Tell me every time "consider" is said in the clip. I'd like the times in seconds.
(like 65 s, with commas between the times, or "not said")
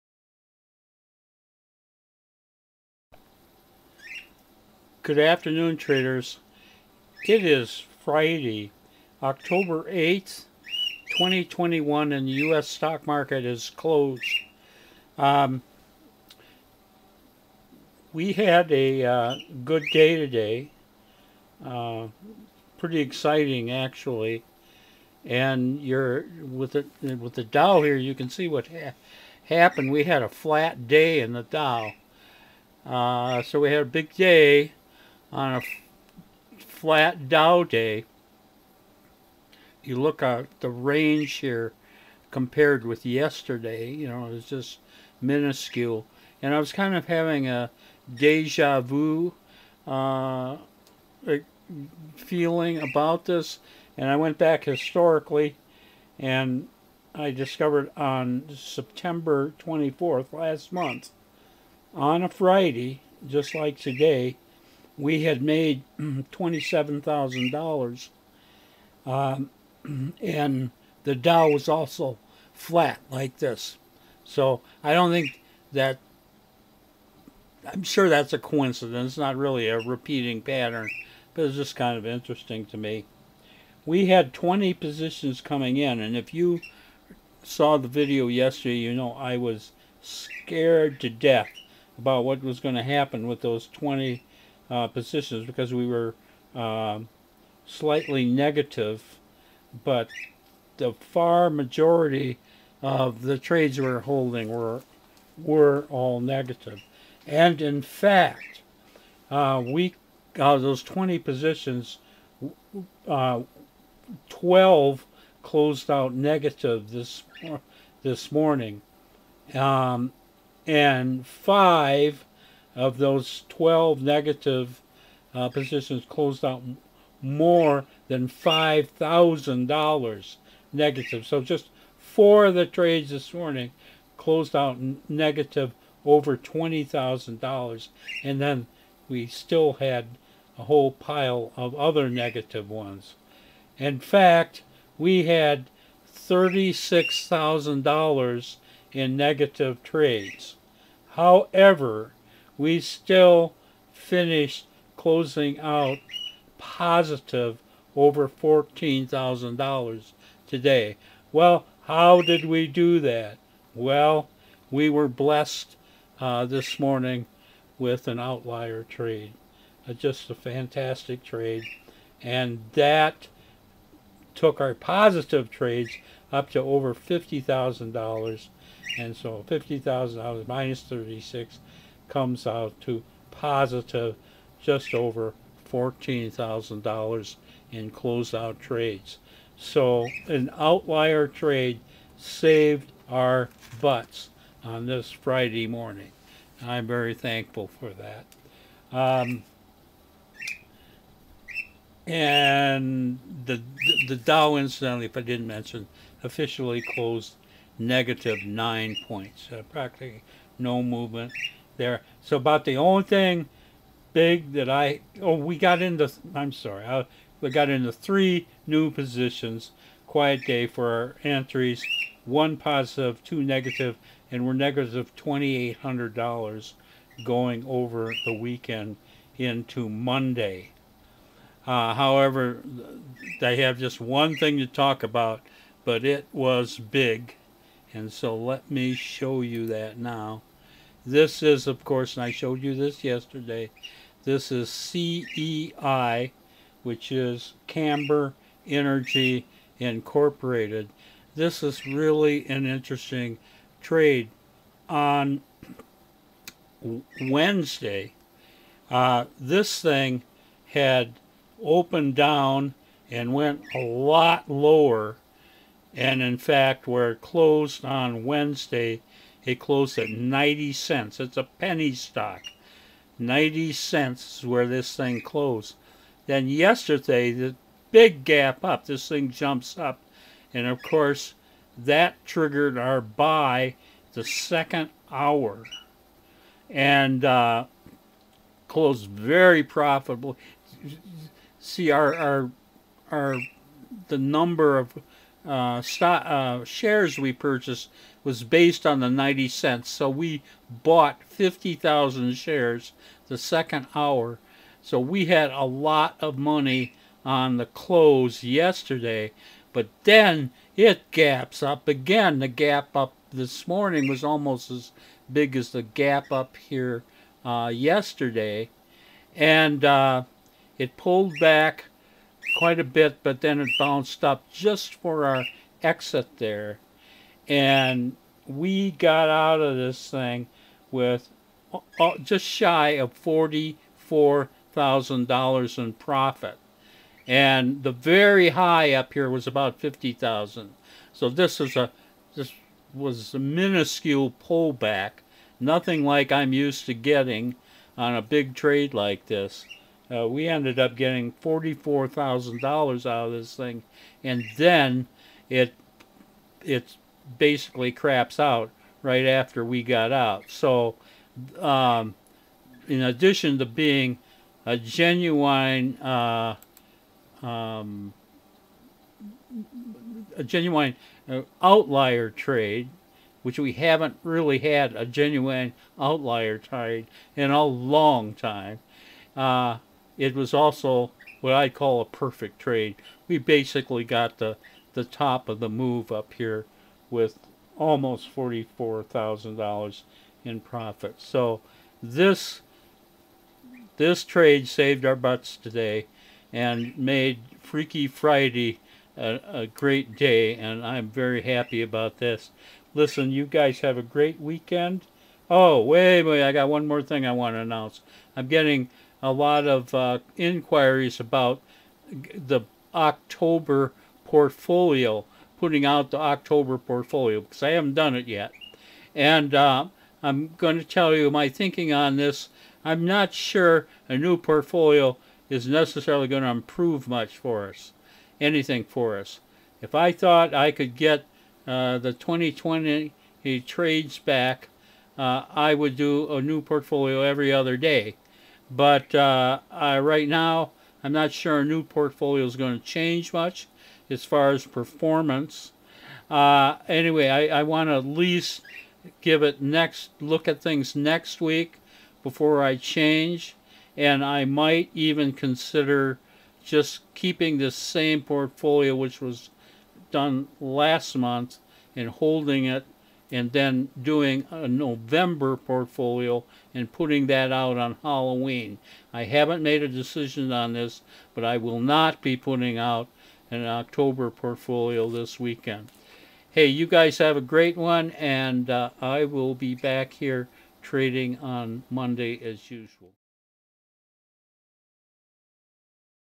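455 s.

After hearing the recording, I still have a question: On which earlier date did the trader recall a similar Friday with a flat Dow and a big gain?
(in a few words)
September 24th.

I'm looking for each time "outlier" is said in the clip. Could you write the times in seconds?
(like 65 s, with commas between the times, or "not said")
168 s, 190 s, 371 s, 375 s.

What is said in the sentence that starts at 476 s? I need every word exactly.
Hey, you guys have a great one, and uh, I will be back here trading on Monday as usual.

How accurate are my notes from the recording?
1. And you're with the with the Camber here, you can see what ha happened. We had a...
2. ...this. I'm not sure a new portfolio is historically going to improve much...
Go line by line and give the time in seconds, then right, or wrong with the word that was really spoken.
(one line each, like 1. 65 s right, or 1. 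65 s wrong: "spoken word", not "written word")
1. 25 s wrong: "Dow", not "Camber"
2. 422 s wrong: "necessarily", not "historically".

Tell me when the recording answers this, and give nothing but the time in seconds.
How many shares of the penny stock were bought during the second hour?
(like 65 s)
301 s.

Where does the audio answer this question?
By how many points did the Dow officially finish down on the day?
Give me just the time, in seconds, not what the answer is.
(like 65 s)
208 s.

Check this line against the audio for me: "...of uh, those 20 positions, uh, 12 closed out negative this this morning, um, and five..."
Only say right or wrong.
right.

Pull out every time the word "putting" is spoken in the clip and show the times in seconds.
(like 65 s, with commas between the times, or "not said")
415 s, 466 s, 472 s.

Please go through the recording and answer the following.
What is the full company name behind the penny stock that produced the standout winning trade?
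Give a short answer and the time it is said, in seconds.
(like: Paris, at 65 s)
Camber Energy Incorporated, at 247 s.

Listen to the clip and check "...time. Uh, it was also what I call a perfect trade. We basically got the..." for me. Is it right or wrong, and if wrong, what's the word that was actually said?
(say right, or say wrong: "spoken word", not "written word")
right.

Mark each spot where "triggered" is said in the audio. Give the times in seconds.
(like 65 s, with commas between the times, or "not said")
282 s.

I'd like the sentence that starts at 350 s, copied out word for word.
Uh, we ended up getting $44,000 out of this thing, and then it it basically craps out right after we got out.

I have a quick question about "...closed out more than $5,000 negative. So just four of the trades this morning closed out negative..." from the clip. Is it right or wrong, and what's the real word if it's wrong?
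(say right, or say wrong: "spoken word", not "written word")
right.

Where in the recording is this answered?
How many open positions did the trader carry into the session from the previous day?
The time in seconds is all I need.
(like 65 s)
84 s.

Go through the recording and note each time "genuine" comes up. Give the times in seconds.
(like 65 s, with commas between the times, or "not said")
364 s, 370 s, 375 s.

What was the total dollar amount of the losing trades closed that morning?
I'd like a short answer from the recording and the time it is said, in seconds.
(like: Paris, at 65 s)
$36,000, at 146 s.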